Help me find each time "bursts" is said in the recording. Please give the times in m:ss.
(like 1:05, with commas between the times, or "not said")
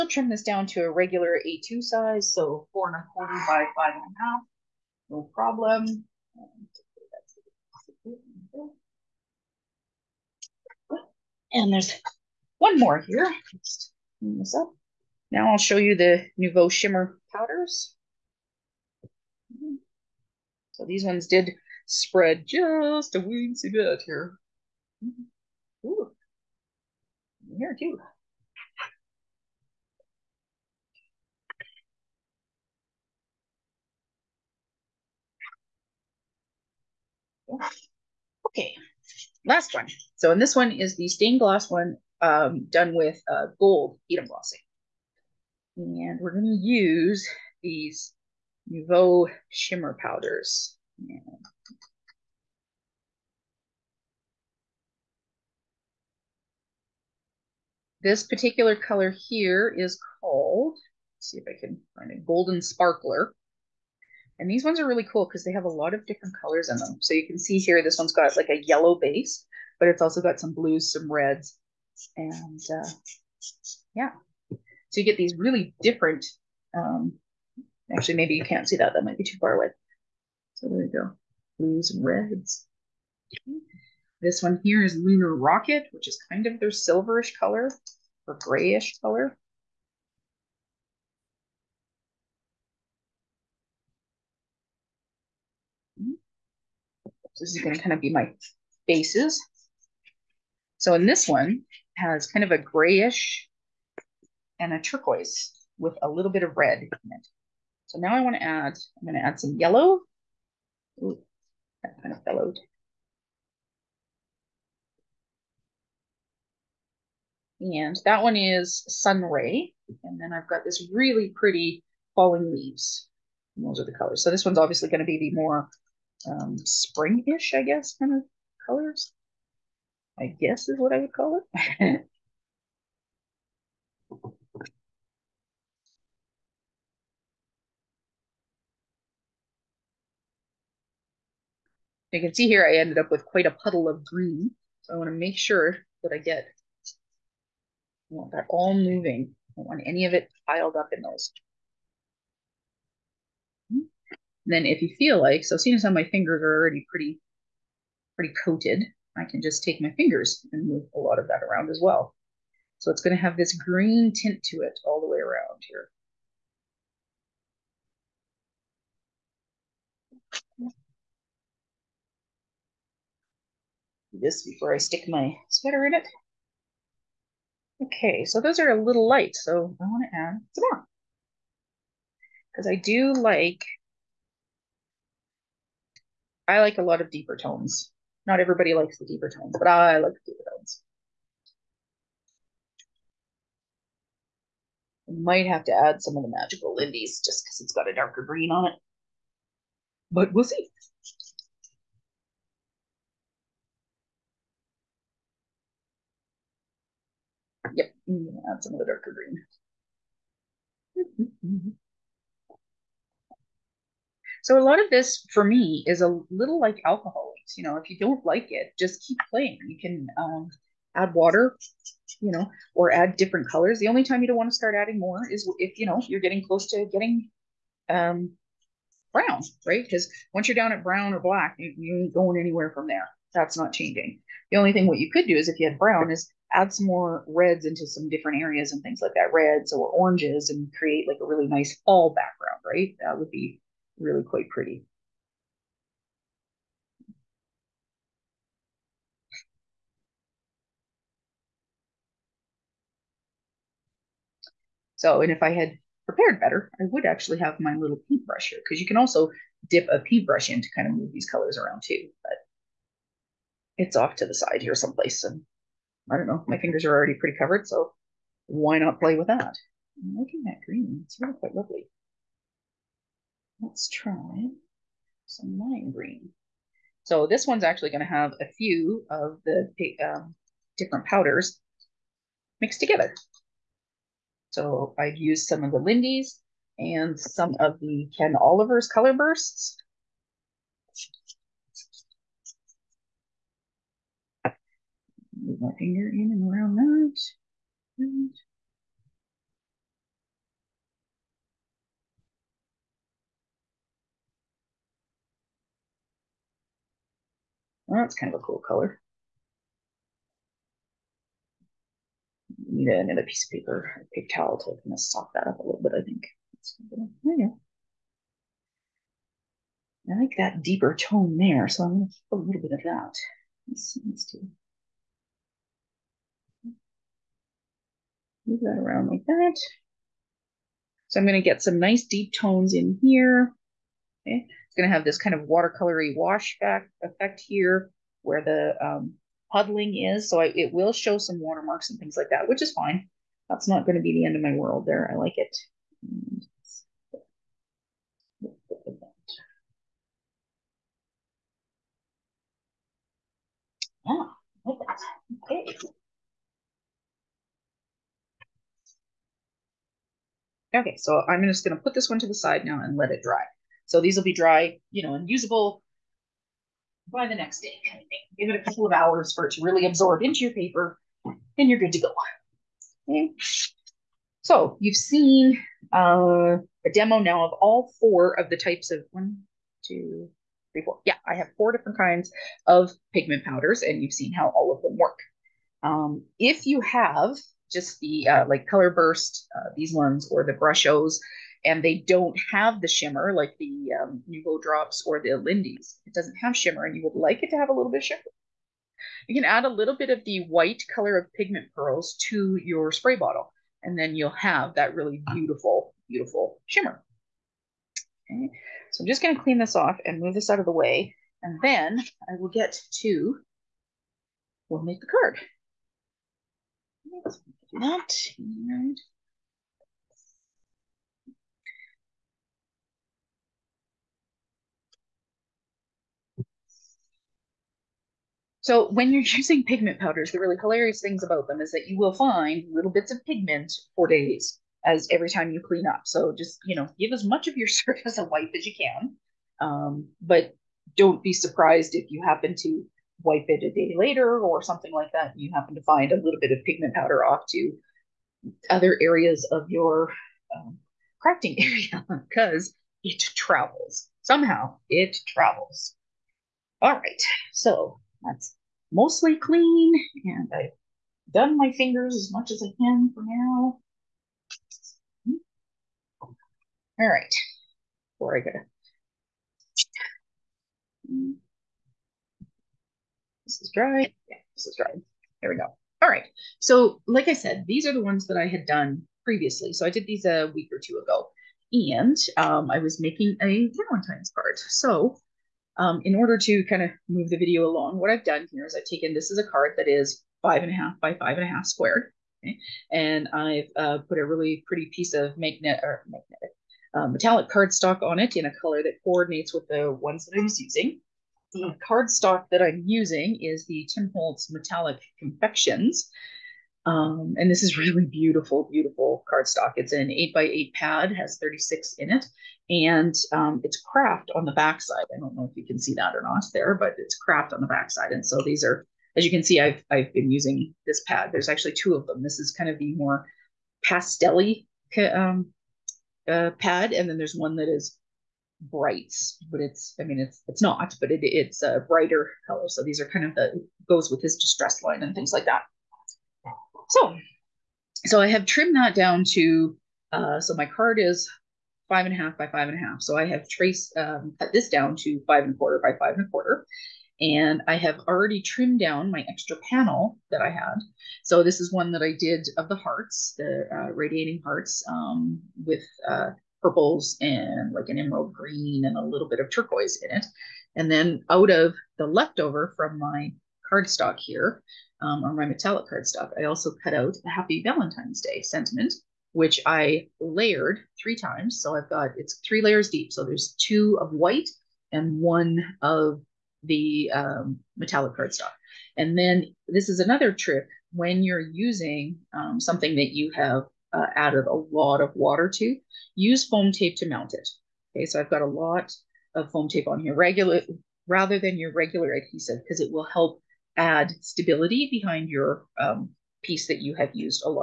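4:49, 6:28.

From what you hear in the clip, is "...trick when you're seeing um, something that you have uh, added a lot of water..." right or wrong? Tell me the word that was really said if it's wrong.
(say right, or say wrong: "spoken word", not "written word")
wrong: "using", not "seeing".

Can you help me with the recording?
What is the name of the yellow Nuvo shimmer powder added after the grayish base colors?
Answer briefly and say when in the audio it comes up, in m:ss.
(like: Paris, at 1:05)
Sunray, at 1:58.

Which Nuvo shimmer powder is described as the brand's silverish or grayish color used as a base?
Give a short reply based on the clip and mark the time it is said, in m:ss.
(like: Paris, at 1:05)
Lunar Rocket, at 1:24.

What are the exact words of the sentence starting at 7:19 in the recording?
Um, but don't be surprised if you happen to wipe it a day later or something like that.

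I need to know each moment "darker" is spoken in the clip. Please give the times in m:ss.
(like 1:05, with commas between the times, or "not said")
3:17, 3:28.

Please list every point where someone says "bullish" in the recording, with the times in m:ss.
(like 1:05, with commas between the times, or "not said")
not said.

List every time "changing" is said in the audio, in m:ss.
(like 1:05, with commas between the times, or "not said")
3:53.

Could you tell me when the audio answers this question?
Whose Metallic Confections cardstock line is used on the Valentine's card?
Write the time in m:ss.
8:23.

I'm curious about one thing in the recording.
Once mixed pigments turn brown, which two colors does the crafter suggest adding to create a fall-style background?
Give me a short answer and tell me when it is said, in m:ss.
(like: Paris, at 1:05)
reds or oranges, at 3:59.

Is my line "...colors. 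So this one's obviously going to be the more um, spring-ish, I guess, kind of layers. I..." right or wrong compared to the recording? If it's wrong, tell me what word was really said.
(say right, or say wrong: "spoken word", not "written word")
wrong: "colors", not "layers".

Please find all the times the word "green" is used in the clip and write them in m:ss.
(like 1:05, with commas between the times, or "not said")
2:24, 2:43, 3:18, 3:29, 4:30, 4:35, 9:18.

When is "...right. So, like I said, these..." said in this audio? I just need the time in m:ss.
7:56.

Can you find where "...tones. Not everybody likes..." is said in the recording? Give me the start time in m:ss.
3:07.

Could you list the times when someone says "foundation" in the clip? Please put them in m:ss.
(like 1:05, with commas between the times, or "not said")
not said.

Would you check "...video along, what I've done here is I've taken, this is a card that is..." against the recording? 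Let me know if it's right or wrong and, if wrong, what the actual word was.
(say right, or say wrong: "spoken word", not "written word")
right.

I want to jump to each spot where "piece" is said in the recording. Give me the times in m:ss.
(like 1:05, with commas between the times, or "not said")
5:13, 8:14, 9:56.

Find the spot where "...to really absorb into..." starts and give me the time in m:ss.
6:09.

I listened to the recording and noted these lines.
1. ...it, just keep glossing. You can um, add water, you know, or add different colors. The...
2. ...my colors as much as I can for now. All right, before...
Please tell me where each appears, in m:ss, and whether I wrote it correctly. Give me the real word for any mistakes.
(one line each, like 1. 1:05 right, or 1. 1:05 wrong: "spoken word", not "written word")
1. 3:38 wrong: "playing", not "glossing"
2. 7:41 wrong: "fingers", not "colors".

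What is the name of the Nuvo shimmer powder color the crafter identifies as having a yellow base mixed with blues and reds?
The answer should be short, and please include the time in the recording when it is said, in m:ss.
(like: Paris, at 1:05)
Golden Sparkler, at 1:02.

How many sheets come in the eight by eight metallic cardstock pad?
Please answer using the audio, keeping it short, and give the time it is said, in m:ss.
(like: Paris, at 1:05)
36, at 8:31.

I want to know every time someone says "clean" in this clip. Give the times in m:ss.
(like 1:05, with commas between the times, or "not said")
0:14, 6:49, 7:15, 7:39.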